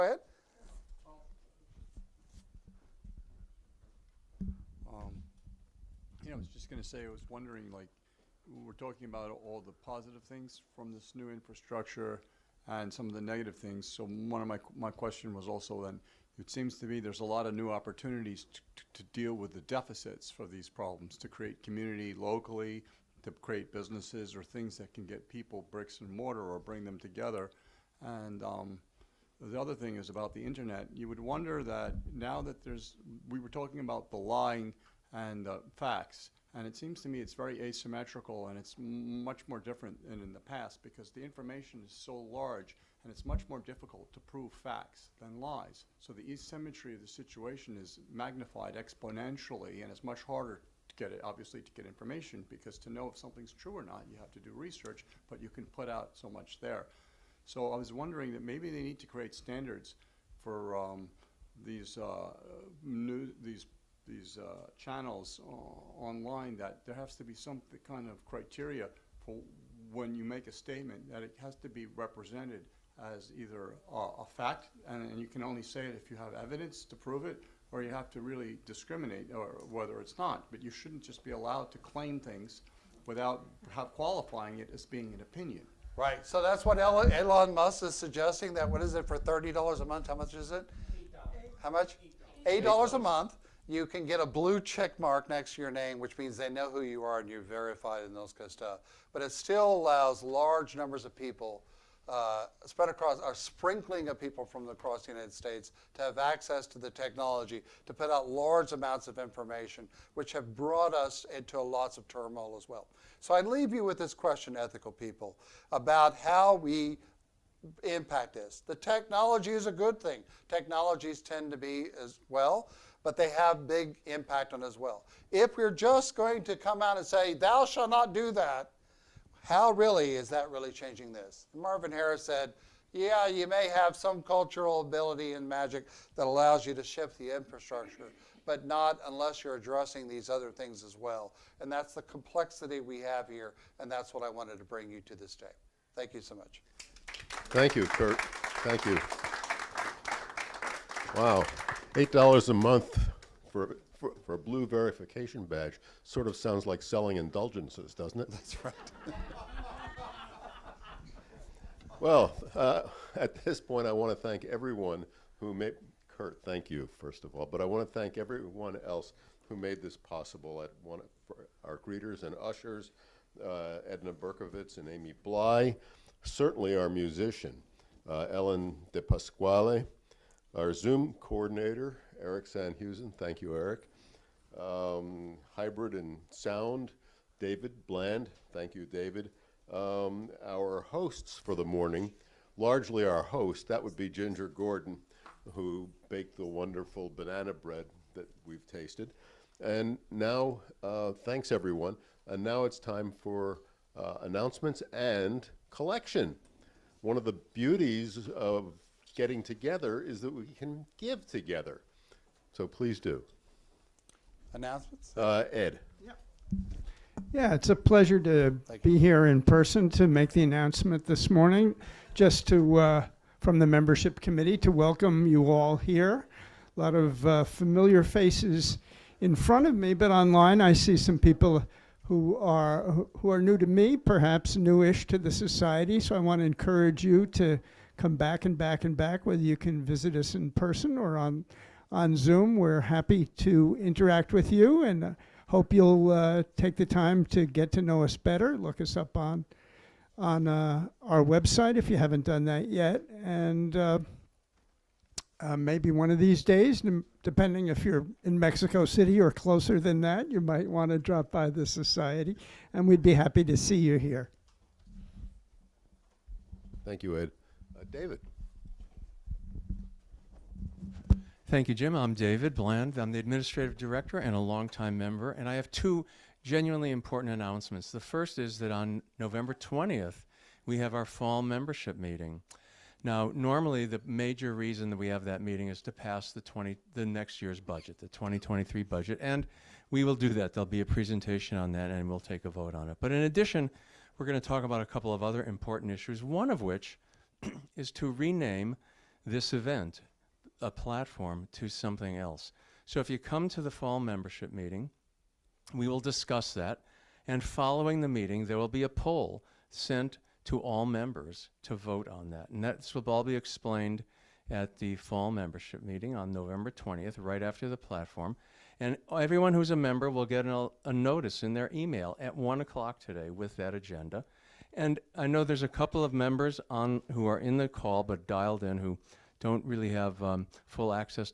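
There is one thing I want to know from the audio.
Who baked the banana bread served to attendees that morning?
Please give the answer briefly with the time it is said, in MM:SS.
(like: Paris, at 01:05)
Ginger Gordon, at 03:14.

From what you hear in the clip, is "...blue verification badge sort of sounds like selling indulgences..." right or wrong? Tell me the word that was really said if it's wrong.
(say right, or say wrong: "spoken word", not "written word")
right.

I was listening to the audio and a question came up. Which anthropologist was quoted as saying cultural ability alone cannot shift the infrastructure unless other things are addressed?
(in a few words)
Marvin Harris.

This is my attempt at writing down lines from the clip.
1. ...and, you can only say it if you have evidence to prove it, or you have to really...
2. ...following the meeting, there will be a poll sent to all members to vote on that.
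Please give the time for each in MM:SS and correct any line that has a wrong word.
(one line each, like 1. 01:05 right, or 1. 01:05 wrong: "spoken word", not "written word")
1. 01:15 right
2. 05:07 right.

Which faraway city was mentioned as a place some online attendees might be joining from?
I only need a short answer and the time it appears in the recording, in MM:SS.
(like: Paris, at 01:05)
Mexico City, at 04:18.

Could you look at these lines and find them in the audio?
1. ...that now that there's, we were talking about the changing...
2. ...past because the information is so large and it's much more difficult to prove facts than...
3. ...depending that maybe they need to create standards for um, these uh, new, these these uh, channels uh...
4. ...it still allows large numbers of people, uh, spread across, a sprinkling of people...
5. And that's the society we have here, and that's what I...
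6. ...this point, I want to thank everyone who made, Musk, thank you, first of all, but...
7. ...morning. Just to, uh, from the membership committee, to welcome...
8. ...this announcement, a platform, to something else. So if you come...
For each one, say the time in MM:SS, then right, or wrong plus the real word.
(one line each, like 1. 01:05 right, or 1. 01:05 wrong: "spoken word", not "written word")
1. 00:31 wrong: "lying", not "changing"
2. 00:40 right
3. 00:57 wrong: "wondering", not "depending"
4. 01:39 right
5. 02:21 wrong: "complexity", not "society"
6. 02:43 wrong: "Curt", not "Musk"
7. 03:41 right
8. 04:59 wrong: "event", not "announcement".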